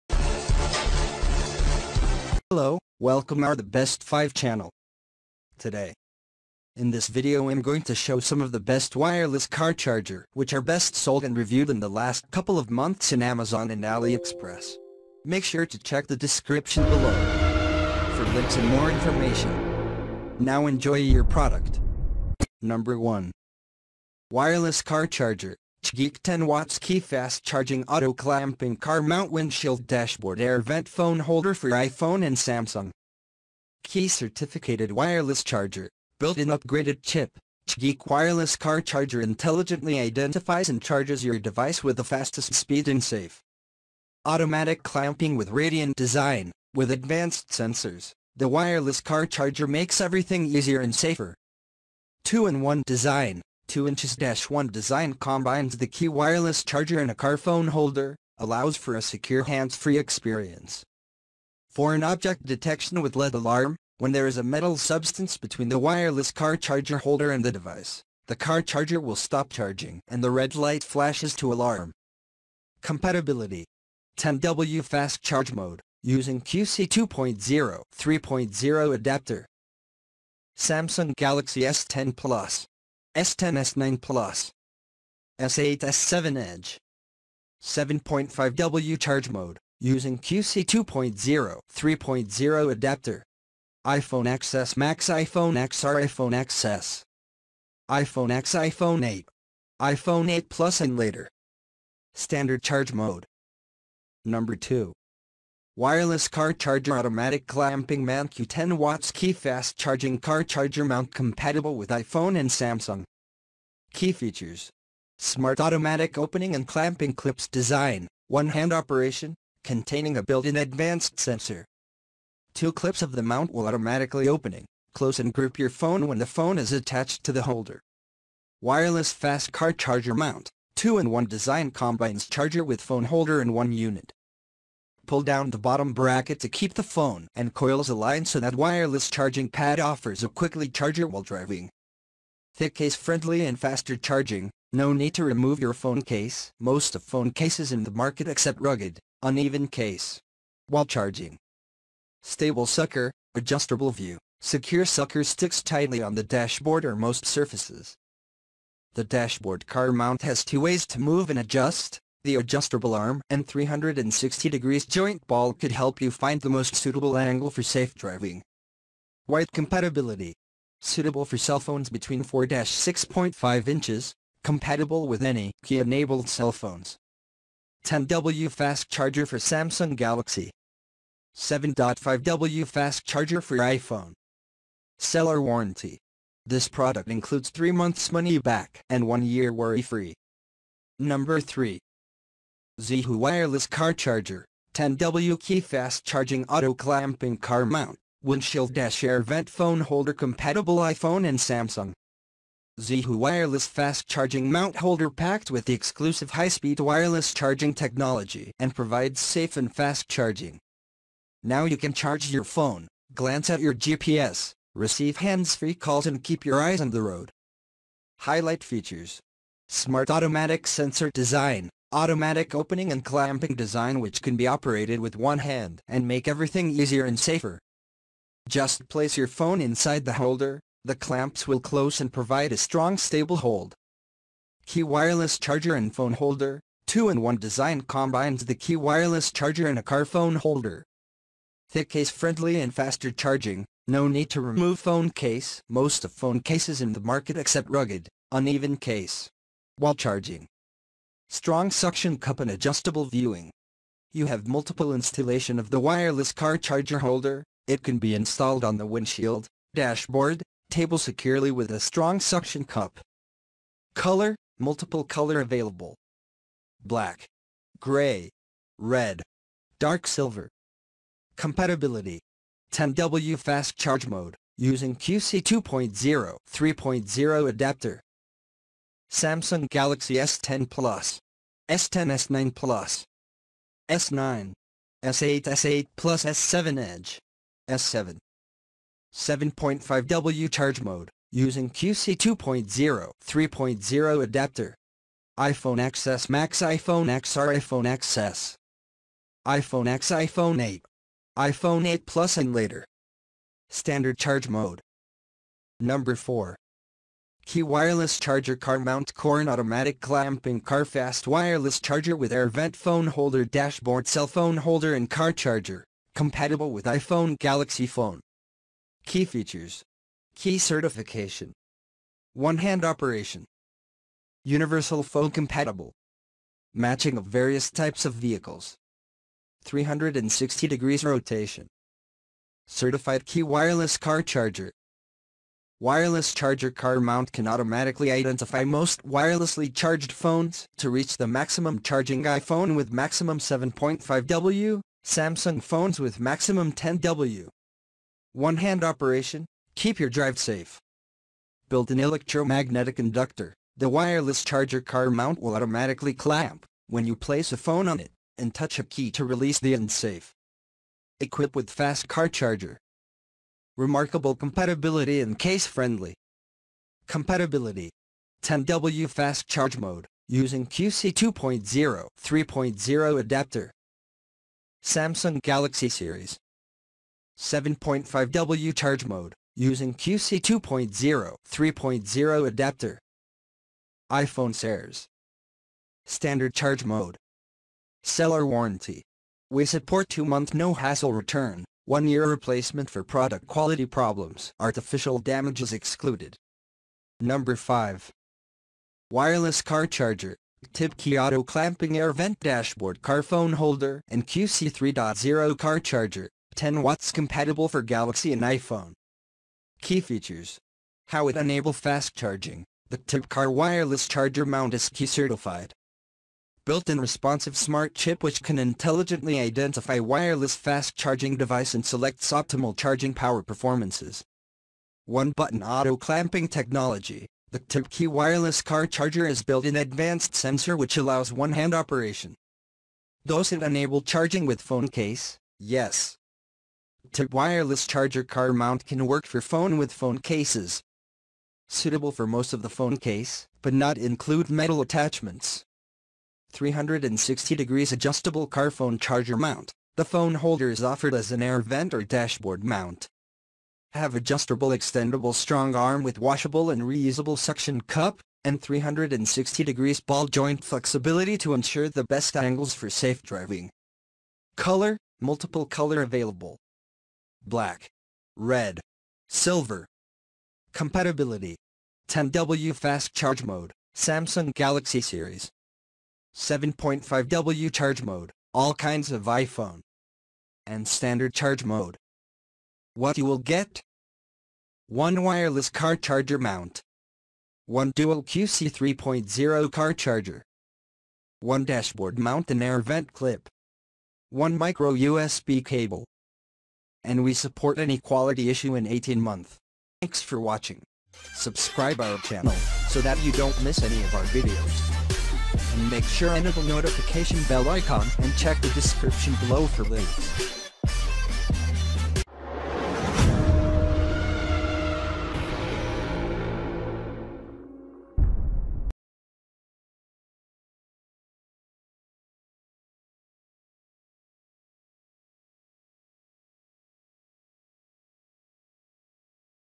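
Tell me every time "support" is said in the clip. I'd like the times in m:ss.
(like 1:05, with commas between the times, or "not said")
6:29, 8:17.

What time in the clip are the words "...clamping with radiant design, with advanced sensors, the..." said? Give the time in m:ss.
0:44.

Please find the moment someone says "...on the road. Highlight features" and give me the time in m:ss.
3:36.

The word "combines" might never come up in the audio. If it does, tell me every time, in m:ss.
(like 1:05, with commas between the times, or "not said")
0:55, 2:11, 3:57.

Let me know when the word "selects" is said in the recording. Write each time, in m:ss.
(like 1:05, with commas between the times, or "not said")
7:01.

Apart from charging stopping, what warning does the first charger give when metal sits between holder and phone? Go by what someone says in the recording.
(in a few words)
red light flashes.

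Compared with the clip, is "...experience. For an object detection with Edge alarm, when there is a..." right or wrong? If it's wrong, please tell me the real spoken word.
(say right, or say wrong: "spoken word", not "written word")
wrong: "LED", not "Edge".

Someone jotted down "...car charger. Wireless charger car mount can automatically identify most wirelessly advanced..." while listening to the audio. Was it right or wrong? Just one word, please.
wrong.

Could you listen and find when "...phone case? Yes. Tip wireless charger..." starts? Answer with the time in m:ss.
7:14.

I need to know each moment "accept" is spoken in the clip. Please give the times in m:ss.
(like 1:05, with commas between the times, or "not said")
2:28, 4:07.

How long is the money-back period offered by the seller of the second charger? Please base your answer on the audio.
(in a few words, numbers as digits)
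3 months.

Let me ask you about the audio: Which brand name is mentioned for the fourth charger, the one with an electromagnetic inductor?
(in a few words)
Corehan.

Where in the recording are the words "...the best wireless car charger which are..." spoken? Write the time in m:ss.
0:08.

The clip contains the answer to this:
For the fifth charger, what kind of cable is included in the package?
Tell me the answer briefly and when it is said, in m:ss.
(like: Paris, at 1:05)
micro USB cable, at 8:14.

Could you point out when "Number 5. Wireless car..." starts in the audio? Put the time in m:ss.
6:37.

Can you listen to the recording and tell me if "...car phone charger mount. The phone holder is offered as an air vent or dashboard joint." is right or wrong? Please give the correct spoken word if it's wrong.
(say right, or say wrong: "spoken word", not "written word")
wrong: "mount", not "joint".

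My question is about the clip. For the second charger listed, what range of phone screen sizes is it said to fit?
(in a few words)
4-6.5 inches.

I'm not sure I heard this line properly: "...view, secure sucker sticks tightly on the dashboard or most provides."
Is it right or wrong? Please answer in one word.
wrong.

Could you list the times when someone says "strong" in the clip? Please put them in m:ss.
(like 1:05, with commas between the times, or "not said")
3:52, 4:11, 4:21, 7:35.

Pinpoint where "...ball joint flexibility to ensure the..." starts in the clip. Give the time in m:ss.
7:39.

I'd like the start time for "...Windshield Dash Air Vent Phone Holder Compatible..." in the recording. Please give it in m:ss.
3:18.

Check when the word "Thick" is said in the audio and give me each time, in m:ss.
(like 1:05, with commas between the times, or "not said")
2:22, 4:01.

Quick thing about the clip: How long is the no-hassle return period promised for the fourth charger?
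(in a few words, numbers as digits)
2 months.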